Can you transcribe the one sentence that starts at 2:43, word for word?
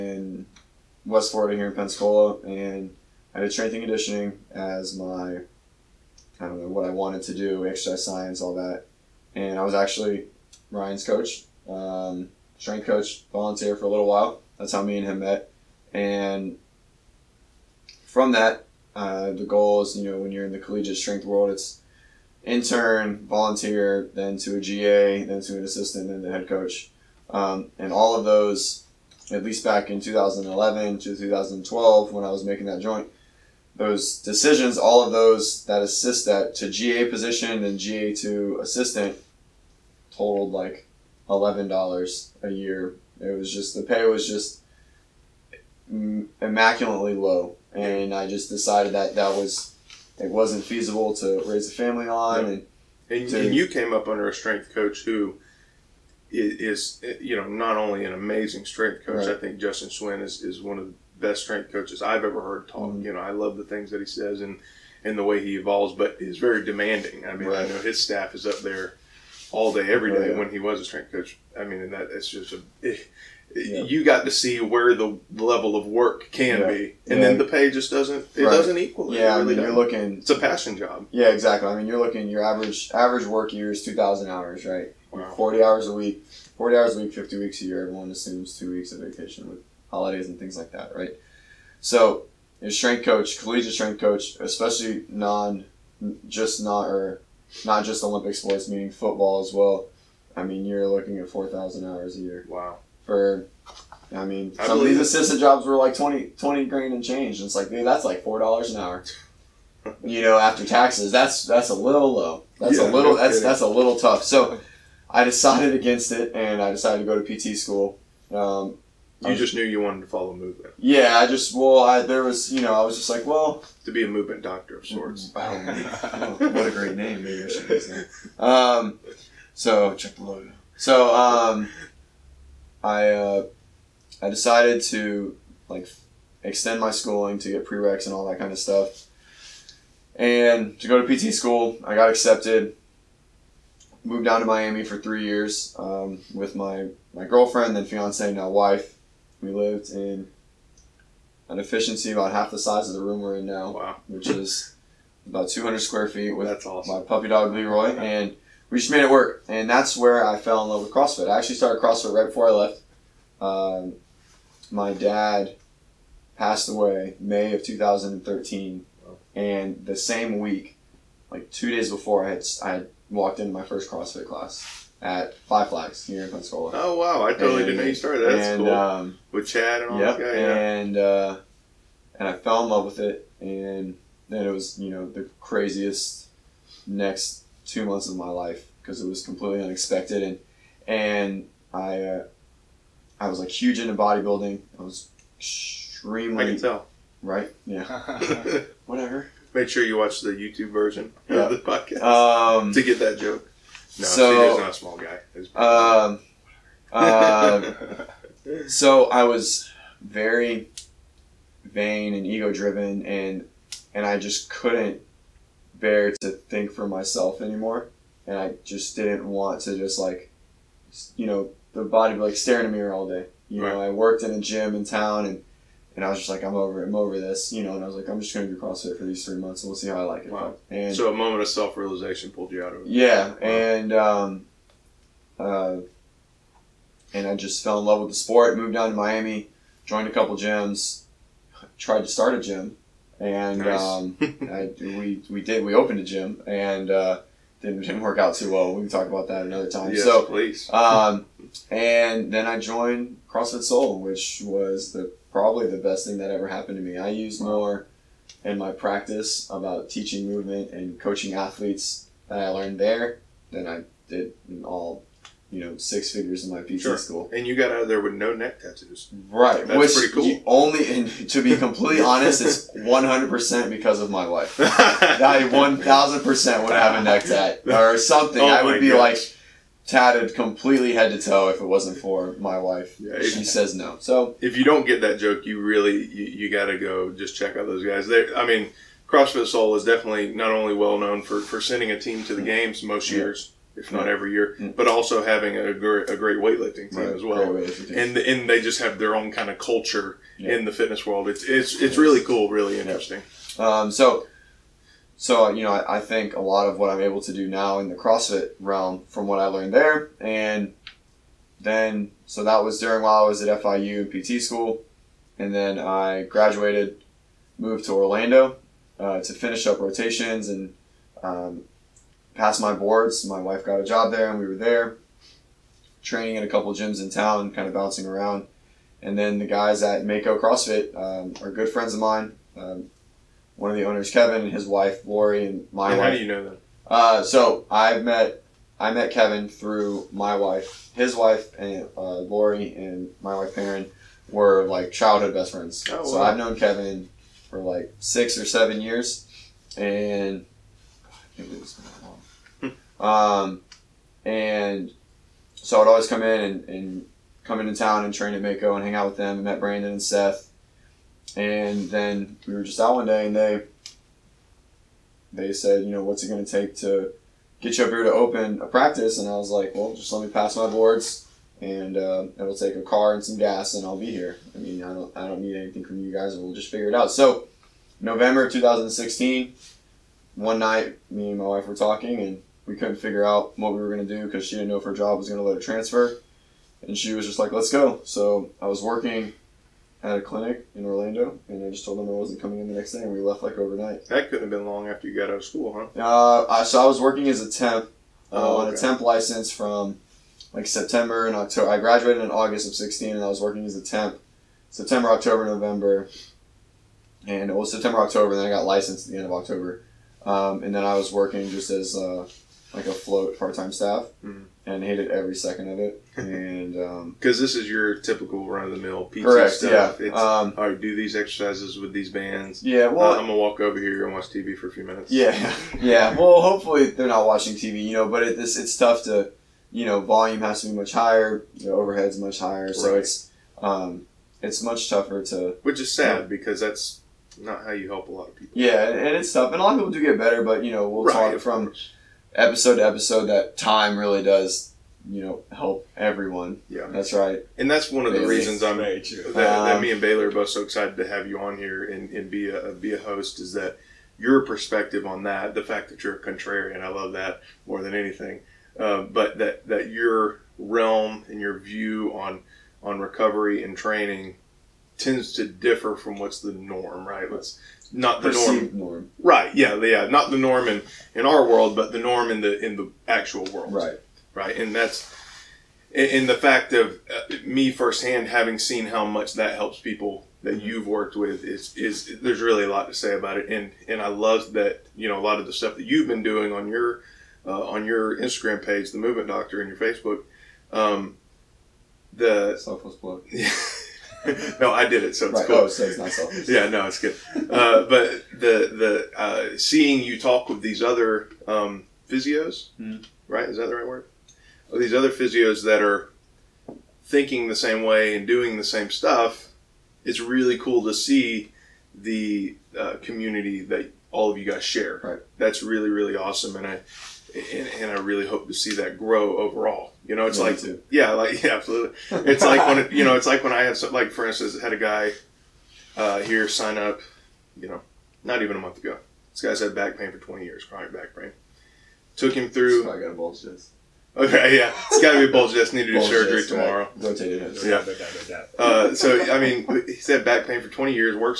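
Um, my dad passed away May of 2013, wow.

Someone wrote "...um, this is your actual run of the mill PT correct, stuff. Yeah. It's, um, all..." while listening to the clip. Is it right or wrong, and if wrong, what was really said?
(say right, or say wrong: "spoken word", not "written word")
wrong: "typical", not "actual".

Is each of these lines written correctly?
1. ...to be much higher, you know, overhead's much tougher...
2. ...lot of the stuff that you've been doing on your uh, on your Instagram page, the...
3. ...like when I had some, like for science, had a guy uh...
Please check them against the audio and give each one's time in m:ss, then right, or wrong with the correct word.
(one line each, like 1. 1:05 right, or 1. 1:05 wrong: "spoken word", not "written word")
1. 7:10 wrong: "higher", not "tougher"
2. 8:05 right
3. 8:43 wrong: "instance", not "science".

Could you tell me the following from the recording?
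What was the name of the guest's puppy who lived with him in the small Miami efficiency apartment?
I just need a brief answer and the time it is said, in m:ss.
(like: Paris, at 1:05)
Leroy, at 2:37.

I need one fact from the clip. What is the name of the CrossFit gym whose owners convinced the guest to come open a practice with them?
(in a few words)
Mako CrossFit.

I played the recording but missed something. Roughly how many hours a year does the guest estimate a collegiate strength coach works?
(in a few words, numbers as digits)
4,000.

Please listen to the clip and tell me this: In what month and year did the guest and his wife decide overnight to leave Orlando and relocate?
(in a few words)
November 2016.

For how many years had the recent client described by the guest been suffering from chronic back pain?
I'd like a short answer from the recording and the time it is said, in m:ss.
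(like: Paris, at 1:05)
20, at 8:50.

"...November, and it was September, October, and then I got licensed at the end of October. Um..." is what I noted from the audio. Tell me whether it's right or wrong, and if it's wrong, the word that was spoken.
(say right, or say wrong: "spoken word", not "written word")
right.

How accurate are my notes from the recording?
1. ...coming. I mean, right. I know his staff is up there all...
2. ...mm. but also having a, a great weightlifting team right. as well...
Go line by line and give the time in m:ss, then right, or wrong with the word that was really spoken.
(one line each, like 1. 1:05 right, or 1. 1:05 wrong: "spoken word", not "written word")
1. 1:06 wrong: "demanding", not "coming"
2. 4:54 right.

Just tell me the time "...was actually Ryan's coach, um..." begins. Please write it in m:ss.
0:09.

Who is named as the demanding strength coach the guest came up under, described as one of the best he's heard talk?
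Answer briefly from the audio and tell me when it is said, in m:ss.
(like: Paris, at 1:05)
Justin Swin, at 0:59.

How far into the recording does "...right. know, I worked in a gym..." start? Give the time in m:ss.
3:43.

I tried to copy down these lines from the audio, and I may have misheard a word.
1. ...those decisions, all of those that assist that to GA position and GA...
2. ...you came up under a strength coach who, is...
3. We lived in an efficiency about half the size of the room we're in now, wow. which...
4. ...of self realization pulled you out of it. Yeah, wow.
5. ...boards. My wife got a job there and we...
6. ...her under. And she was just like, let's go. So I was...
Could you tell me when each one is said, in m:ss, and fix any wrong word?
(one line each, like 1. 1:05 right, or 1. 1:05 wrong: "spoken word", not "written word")
1. 0:33 right
2. 0:53 right
3. 2:29 right
4. 3:51 right
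5. 5:22 right
6. 6:25 wrong: "transfer", not "under".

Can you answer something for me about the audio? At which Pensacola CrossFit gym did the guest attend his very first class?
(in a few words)
Five Flags.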